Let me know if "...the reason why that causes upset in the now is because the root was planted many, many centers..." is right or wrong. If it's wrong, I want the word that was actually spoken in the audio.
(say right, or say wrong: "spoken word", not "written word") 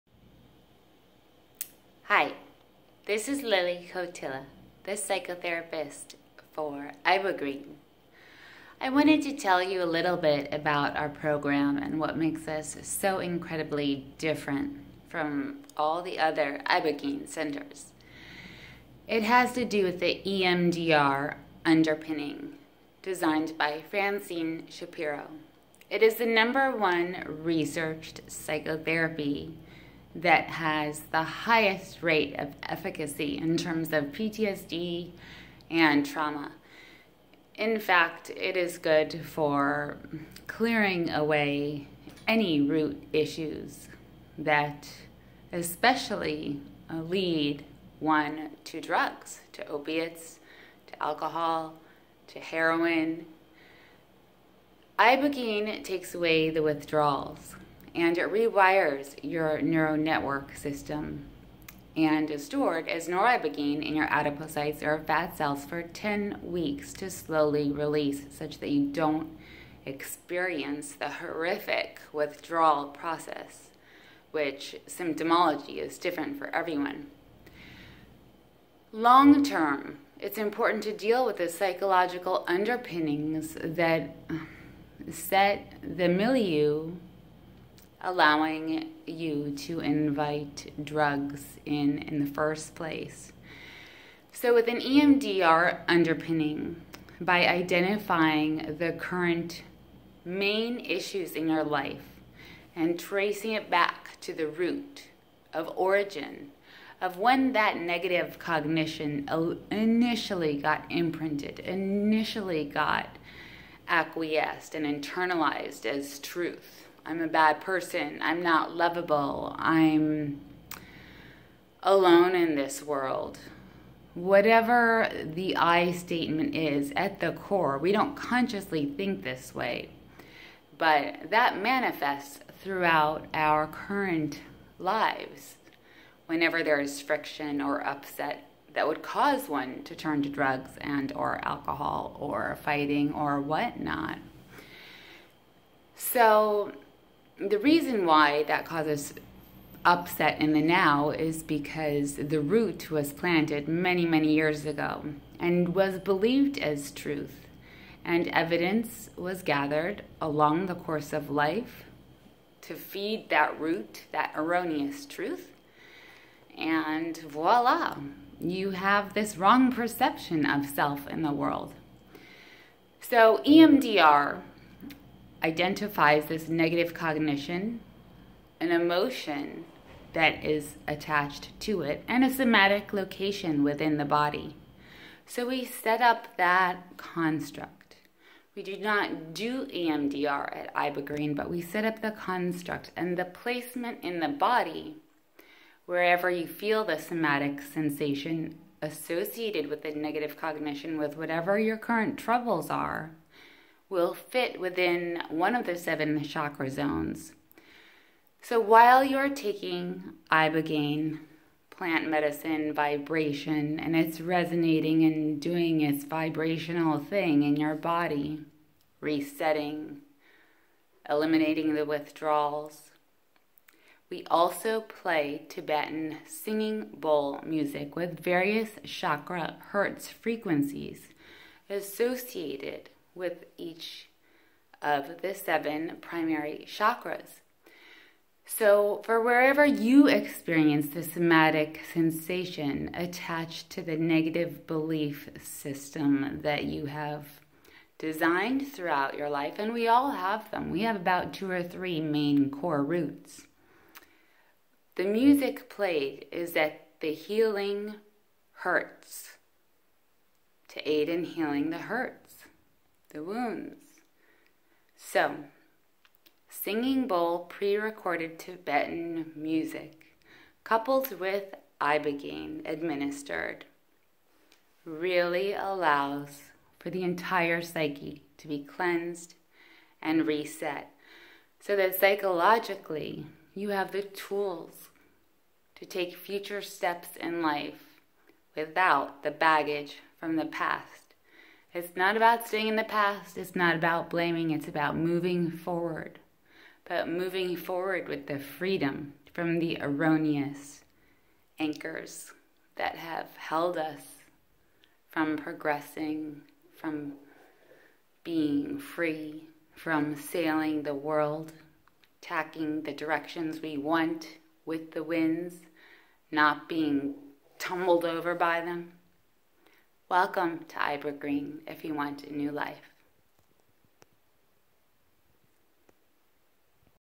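wrong: "years", not "centers".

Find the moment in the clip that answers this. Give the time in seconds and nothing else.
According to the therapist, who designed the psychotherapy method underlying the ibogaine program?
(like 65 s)
23 s.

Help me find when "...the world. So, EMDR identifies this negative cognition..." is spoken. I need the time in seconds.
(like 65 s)
171 s.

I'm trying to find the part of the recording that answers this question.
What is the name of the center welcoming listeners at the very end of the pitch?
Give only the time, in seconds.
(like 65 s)
320 s.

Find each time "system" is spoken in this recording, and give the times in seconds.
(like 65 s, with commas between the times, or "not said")
60 s, 245 s.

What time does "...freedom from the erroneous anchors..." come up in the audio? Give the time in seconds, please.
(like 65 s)
298 s.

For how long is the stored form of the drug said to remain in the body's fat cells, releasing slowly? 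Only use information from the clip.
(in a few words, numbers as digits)
10 weeks.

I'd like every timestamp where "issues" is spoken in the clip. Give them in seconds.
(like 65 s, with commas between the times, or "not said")
43 s, 100 s.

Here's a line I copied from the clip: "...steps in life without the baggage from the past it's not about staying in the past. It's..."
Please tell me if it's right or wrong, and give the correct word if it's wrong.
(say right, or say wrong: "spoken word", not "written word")
right.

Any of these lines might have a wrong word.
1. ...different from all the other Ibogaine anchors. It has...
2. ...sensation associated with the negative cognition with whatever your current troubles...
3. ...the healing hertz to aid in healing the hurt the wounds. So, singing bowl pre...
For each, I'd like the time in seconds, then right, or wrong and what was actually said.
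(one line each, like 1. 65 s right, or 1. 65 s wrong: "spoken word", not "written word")
1. 14 s wrong: "centers", not "anchors"
2. 197 s right
3. 256 s right.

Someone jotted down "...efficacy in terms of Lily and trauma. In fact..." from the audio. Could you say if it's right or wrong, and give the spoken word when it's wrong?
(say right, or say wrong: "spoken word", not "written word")
wrong: "PTSD", not "Lily".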